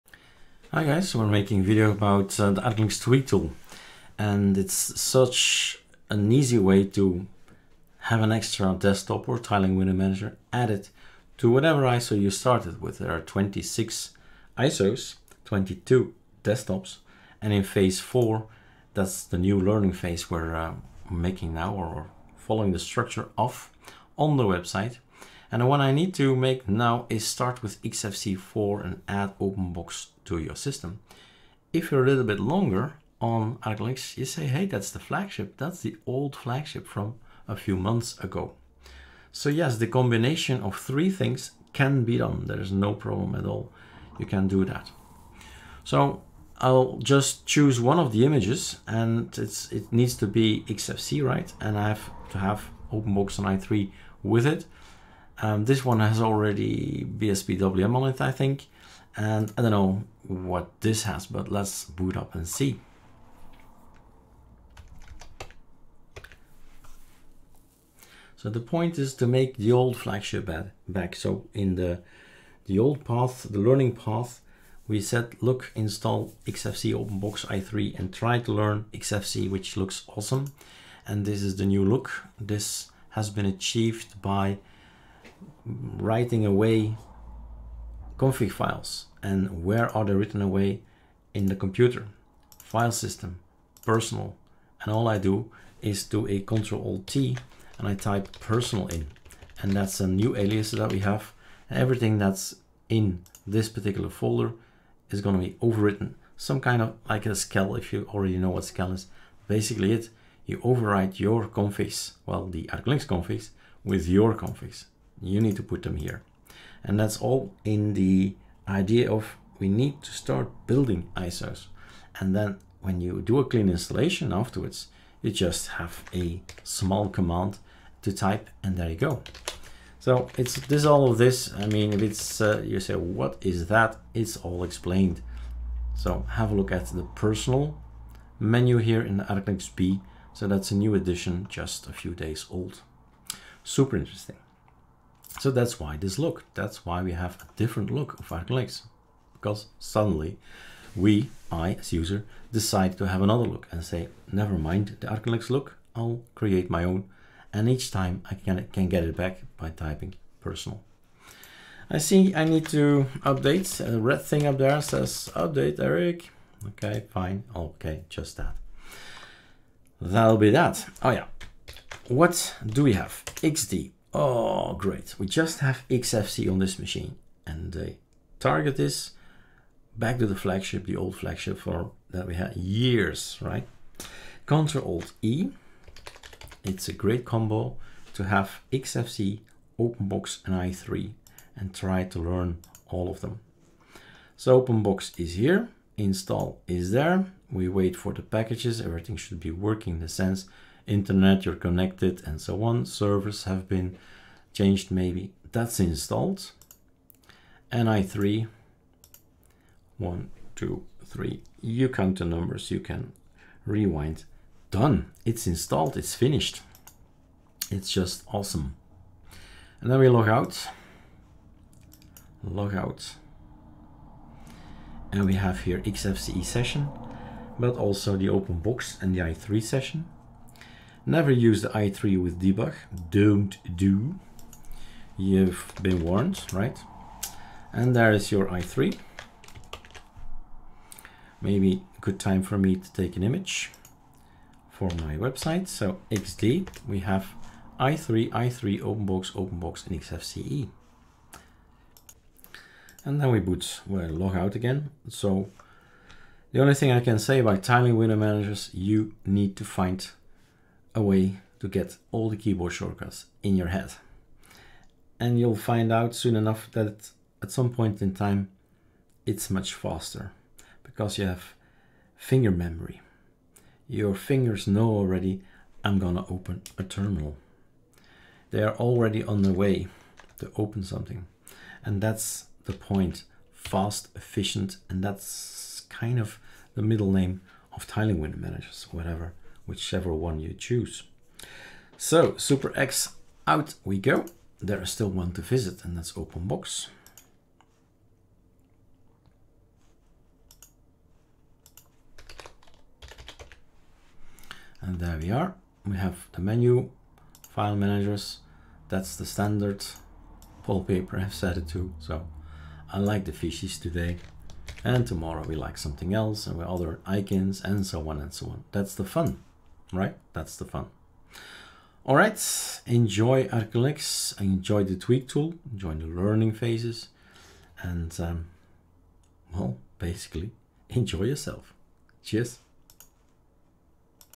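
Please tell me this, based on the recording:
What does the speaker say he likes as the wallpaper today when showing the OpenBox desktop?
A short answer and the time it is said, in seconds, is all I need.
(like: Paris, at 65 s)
the fishes, at 313 s.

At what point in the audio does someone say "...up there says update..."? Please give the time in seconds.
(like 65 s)
164 s.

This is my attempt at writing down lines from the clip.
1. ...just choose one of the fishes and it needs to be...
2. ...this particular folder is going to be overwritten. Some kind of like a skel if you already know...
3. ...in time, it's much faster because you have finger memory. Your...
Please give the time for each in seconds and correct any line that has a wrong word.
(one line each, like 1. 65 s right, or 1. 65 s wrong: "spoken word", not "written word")
1. 47 s wrong: "images", not "fishes"
2. 103 s right
3. 268 s right.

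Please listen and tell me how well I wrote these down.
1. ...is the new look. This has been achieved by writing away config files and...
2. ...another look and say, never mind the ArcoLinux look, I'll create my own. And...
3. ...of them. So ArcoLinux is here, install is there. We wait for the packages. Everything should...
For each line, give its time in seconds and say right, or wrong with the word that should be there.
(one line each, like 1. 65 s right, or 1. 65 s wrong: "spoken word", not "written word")
1. 81 s right
2. 153 s right
3. 193 s wrong: "OpenBox", not "ArcoLinux".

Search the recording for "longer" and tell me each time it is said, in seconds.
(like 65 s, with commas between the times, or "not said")
32 s.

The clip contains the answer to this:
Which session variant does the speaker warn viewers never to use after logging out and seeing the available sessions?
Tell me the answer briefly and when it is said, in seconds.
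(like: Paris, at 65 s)
i3 with debug, at 231 s.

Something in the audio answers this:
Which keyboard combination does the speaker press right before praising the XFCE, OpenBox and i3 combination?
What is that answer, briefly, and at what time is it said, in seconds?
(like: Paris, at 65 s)
Ctrl Alt E, at 184 s.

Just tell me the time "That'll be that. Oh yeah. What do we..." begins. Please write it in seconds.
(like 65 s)
169 s.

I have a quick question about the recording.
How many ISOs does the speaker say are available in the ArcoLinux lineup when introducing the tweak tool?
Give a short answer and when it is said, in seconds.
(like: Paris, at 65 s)
26, at 13 s.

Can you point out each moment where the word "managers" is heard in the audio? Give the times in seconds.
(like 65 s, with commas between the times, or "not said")
9 s, 258 s, 288 s, 307 s.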